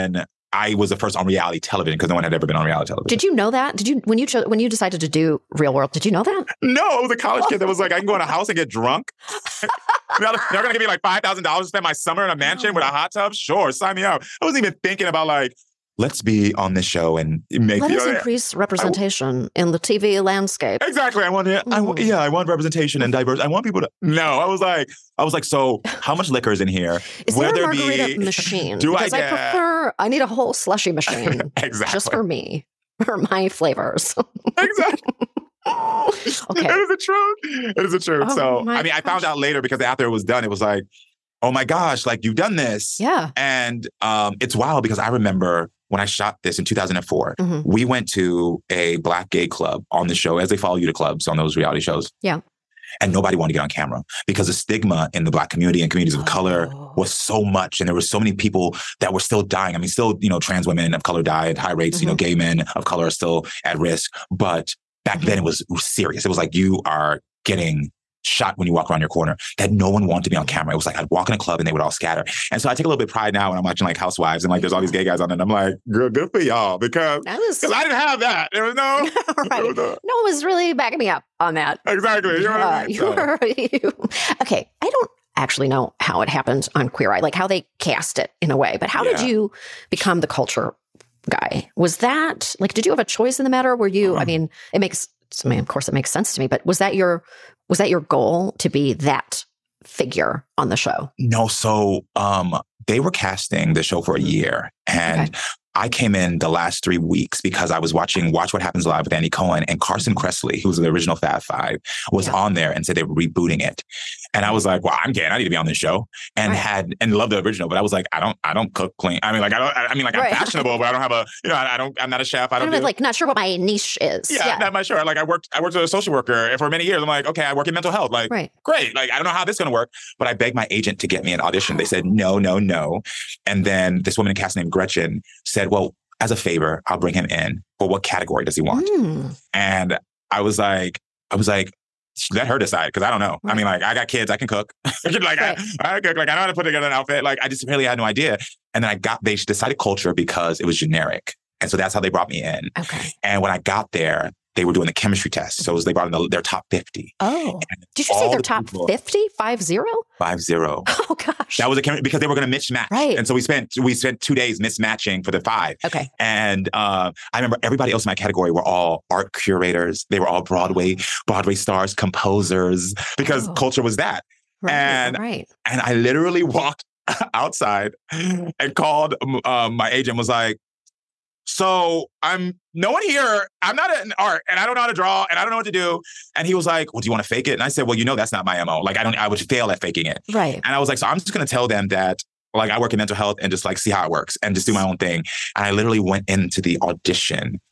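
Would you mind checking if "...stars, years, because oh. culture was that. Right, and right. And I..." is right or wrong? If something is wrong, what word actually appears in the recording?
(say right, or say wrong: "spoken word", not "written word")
wrong: "composers", not "years".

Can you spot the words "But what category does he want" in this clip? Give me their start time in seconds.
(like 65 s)
137 s.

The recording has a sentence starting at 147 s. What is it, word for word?
Like I just really had no idea.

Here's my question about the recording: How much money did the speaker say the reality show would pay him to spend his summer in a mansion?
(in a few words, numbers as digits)
$5,000.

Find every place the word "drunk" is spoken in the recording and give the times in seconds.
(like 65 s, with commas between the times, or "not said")
8 s.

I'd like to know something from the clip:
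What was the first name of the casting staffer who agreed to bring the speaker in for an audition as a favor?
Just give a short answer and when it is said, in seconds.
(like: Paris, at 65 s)
Gretchen, at 134 s.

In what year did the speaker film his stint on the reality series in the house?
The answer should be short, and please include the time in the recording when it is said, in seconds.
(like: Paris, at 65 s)
2004, at 46 s.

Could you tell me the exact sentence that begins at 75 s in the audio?
And I'm like, girl, good for y'all because I was I didn't have that.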